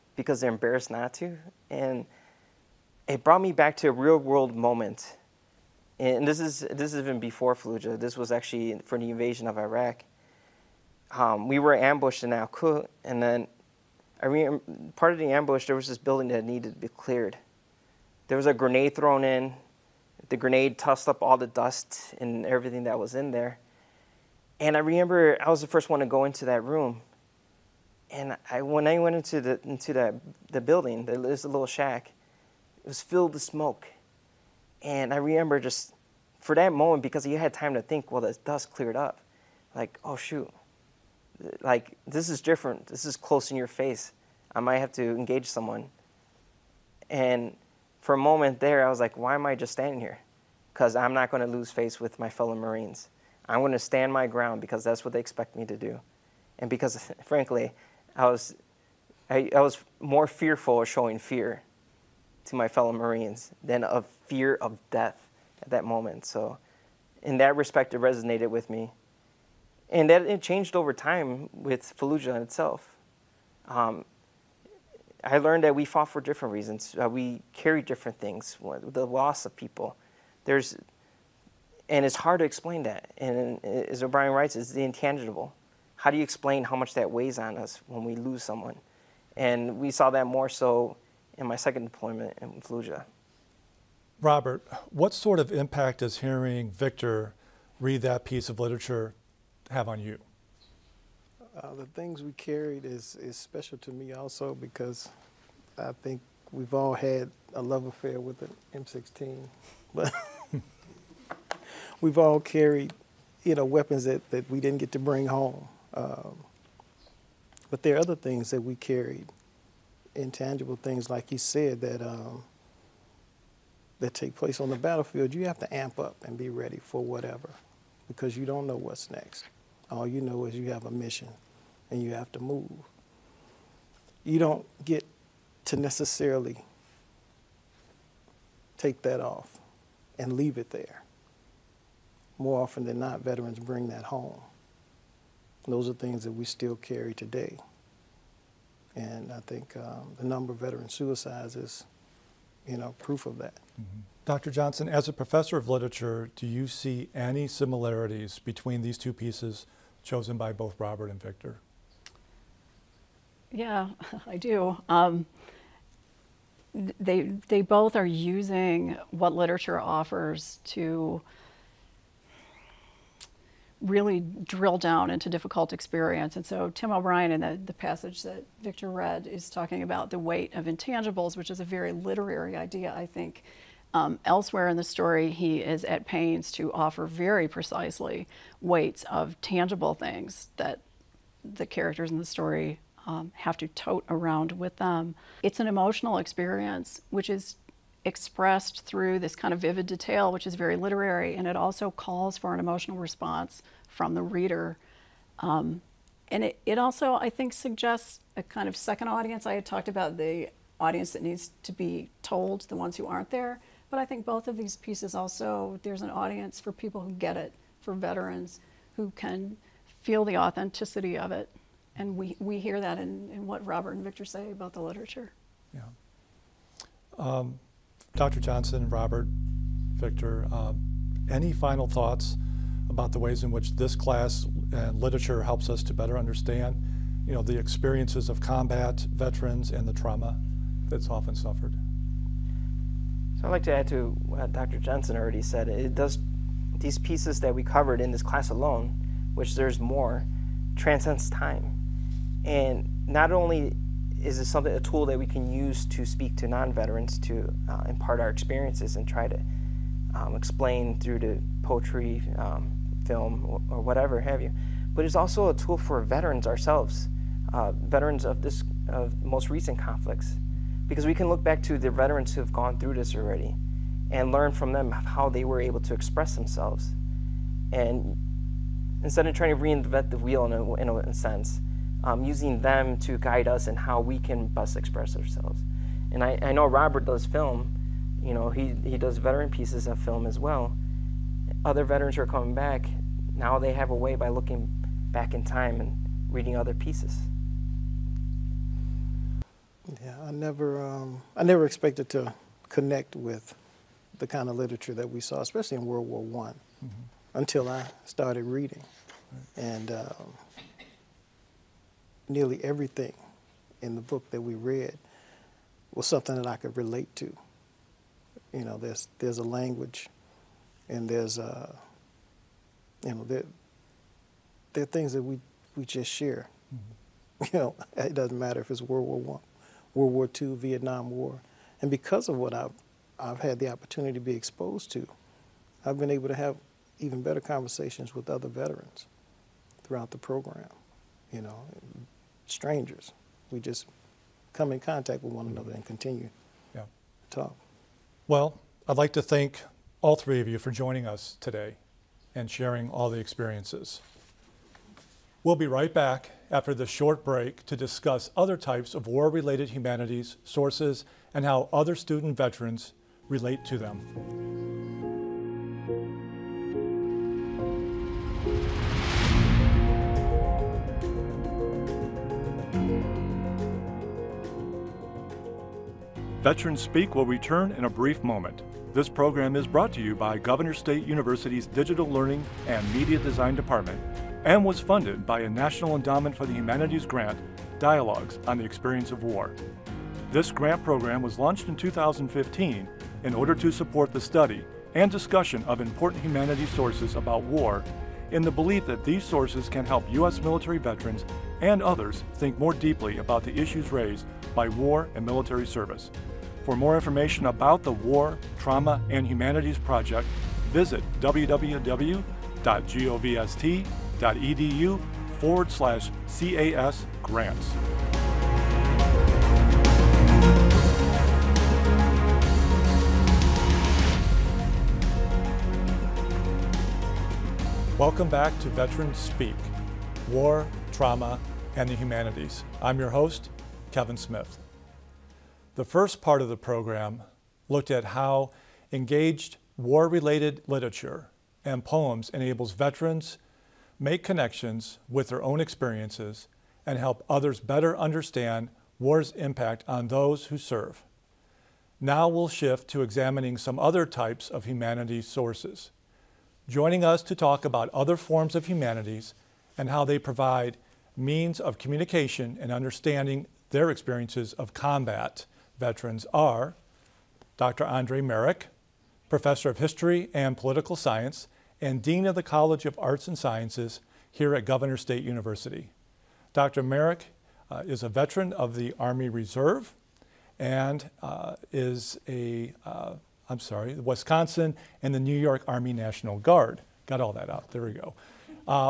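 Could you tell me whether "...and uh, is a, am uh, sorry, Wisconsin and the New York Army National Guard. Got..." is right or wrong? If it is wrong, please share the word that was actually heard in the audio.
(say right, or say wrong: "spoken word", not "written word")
right.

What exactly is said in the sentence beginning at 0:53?
I'm going to stand my ground because that's what they expect me to do.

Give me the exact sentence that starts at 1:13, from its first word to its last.
Um, I learned that we fought for different reasons.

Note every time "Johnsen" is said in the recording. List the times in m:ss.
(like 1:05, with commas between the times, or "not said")
2:34, 3:48, 4:04.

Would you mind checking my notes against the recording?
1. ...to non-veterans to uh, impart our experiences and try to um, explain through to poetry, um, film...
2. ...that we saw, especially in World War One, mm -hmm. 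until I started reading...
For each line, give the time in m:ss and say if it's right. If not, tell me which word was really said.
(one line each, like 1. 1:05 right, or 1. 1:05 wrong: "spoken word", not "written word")
1. 4:16 right
2. 5:04 right.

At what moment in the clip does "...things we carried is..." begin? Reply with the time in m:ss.
1:41.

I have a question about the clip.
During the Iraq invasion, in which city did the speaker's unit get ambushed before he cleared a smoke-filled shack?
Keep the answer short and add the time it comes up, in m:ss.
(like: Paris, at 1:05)
Al Kut, at 0:12.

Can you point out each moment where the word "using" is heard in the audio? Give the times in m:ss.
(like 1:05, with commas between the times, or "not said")
2:48, 4:42.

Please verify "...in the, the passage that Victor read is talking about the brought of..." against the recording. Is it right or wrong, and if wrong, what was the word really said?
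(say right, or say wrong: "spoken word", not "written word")
wrong: "weight", not "brought".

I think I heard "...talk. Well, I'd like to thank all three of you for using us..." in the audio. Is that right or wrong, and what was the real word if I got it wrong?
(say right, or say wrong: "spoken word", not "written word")
wrong: "joining", not "using".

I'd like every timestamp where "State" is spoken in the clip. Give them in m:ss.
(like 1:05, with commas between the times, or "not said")
6:20, 7:55.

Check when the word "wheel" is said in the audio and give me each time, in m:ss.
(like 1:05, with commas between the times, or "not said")
4:40.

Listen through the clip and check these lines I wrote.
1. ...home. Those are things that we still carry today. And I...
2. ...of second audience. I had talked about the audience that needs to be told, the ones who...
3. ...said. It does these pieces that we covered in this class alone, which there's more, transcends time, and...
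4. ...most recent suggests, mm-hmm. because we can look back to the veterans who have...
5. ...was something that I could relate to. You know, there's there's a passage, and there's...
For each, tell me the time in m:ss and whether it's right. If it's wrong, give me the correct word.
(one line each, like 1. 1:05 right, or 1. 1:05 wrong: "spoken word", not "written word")
1. 2:24 right
2. 3:28 right
3. 4:05 right
4. 4:29 wrong: "conflicts", not "suggests"
5. 5:15 wrong: "language", not "passage".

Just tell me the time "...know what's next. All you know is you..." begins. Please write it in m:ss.
2:08.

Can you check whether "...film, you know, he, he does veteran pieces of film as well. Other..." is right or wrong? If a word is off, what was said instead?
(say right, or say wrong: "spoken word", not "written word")
right.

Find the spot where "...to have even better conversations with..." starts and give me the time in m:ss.
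5:36.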